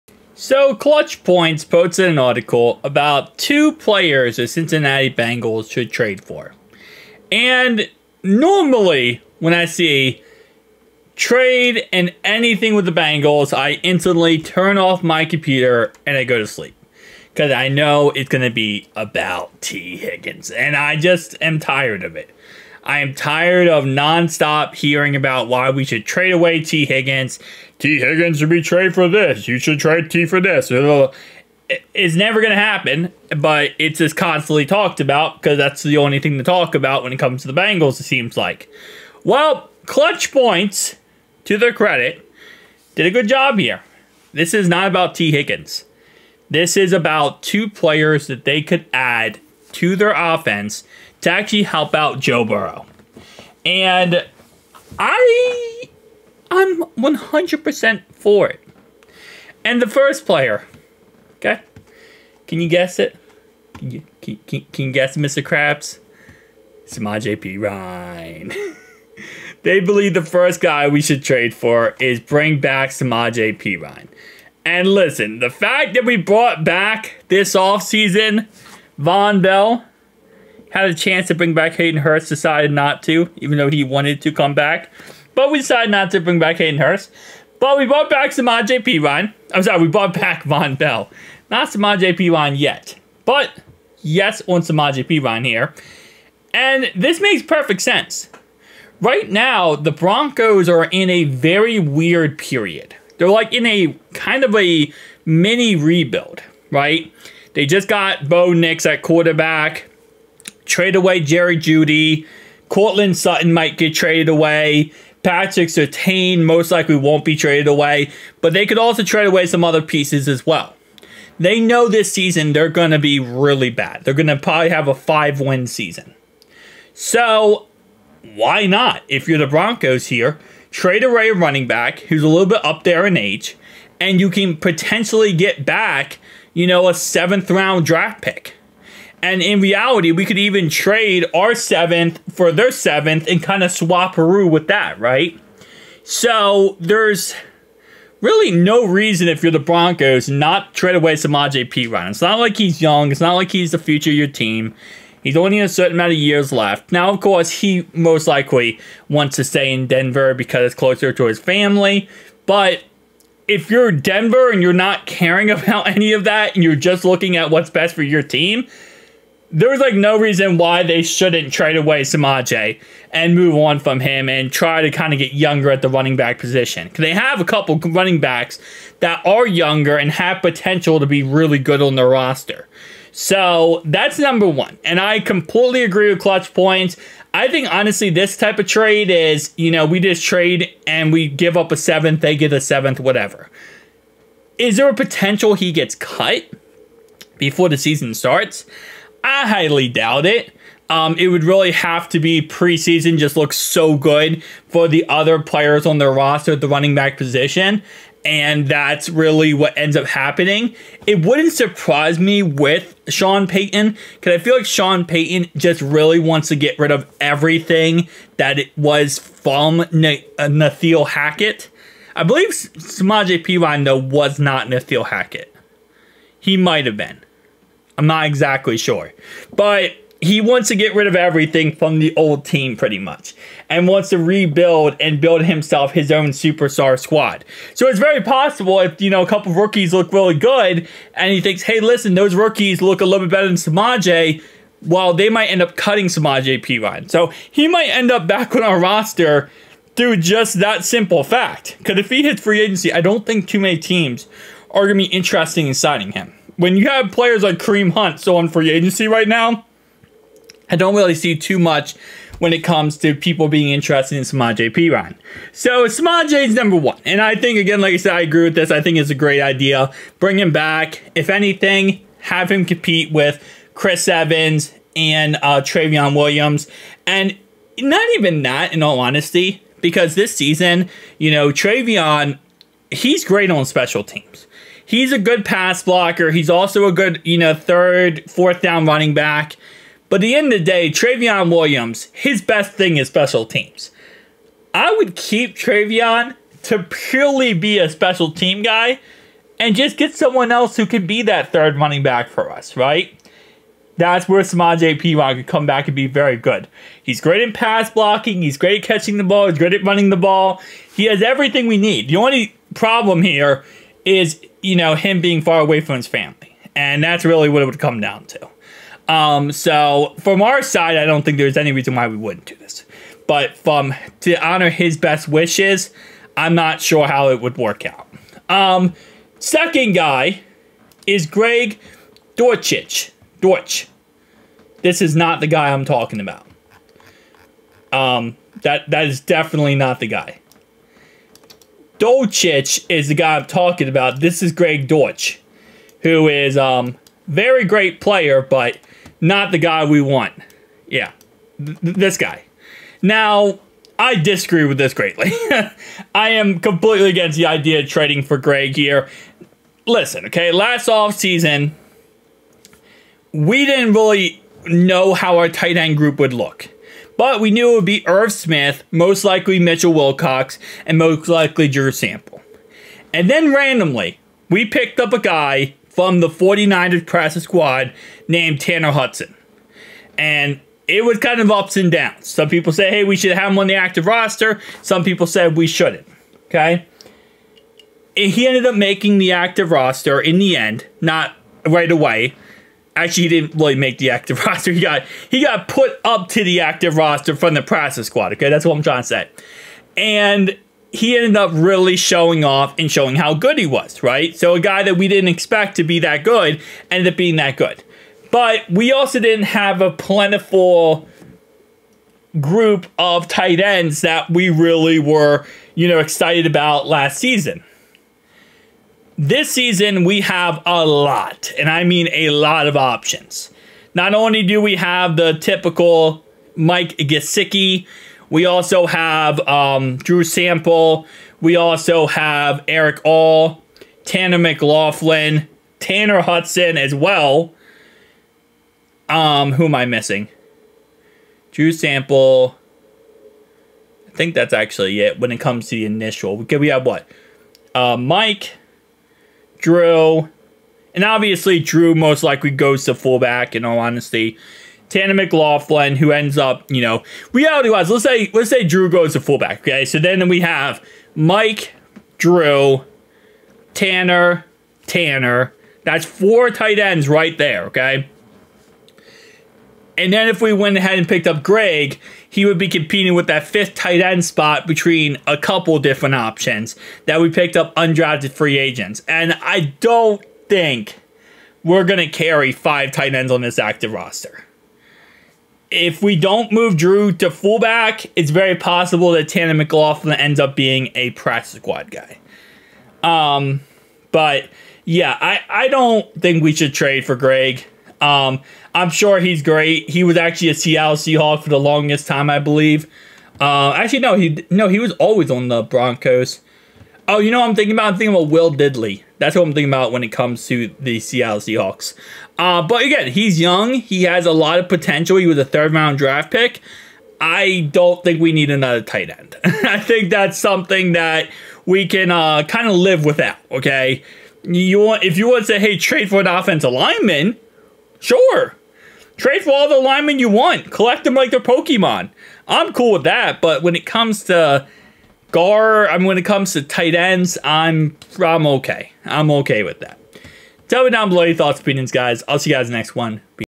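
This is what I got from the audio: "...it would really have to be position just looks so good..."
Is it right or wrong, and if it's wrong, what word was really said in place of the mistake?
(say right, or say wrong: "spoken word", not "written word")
wrong: "preseason", not "position".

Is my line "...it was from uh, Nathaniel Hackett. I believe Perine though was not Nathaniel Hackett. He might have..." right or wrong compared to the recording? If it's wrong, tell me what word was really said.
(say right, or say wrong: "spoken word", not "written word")
right.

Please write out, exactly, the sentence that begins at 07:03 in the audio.
Not only do we have the typical Mike Gesicki, we also have um, Drew Sample.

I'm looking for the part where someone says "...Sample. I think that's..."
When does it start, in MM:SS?
07:21.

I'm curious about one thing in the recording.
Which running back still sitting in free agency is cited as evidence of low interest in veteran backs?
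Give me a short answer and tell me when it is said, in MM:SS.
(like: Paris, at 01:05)
Kareem Hunt, at 04:17.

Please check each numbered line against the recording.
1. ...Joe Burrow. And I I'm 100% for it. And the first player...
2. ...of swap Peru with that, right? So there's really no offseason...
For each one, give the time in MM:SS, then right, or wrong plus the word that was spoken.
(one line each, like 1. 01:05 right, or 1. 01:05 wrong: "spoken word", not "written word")
1. 00:52 right
2. 02:23 wrong: "reason", not "offseason".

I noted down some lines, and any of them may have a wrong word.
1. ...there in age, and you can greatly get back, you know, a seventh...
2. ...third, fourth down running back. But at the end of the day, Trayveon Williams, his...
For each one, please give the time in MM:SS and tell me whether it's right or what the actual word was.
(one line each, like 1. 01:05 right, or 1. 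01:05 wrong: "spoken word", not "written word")
1. 02:12 wrong: "potentially", not "greatly"
2. 04:47 right.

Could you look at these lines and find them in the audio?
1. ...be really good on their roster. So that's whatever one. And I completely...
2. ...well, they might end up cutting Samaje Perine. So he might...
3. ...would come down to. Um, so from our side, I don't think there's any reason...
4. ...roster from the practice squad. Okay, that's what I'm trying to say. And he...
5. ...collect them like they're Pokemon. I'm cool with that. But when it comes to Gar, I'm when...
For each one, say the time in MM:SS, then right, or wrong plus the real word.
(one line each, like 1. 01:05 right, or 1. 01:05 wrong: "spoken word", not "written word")
1. 03:01 wrong: "number", not "whatever"
2. 04:04 right
3. 05:17 right
4. 06:36 right
5. 08:50 right.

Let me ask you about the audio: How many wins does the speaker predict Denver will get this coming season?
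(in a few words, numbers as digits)
5.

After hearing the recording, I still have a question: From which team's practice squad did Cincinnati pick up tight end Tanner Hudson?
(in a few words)
49ers.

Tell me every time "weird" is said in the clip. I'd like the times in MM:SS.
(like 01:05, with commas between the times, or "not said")
01:41.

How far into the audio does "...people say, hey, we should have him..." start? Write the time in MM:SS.
06:22.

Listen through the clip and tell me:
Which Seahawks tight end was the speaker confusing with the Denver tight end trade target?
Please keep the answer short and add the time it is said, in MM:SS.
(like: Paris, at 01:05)
Will Dissly, at 08:28.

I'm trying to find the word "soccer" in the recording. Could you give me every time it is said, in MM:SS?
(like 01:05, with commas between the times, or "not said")
not said.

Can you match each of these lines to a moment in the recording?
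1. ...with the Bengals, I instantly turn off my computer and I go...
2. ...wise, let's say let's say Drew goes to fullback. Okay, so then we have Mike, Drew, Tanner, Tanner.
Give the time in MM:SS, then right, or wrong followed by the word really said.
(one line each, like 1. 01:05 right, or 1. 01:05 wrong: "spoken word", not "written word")
1. 00:12 right
2. 07:37 right.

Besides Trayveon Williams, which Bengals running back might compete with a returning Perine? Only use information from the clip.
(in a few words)
Chris Evans.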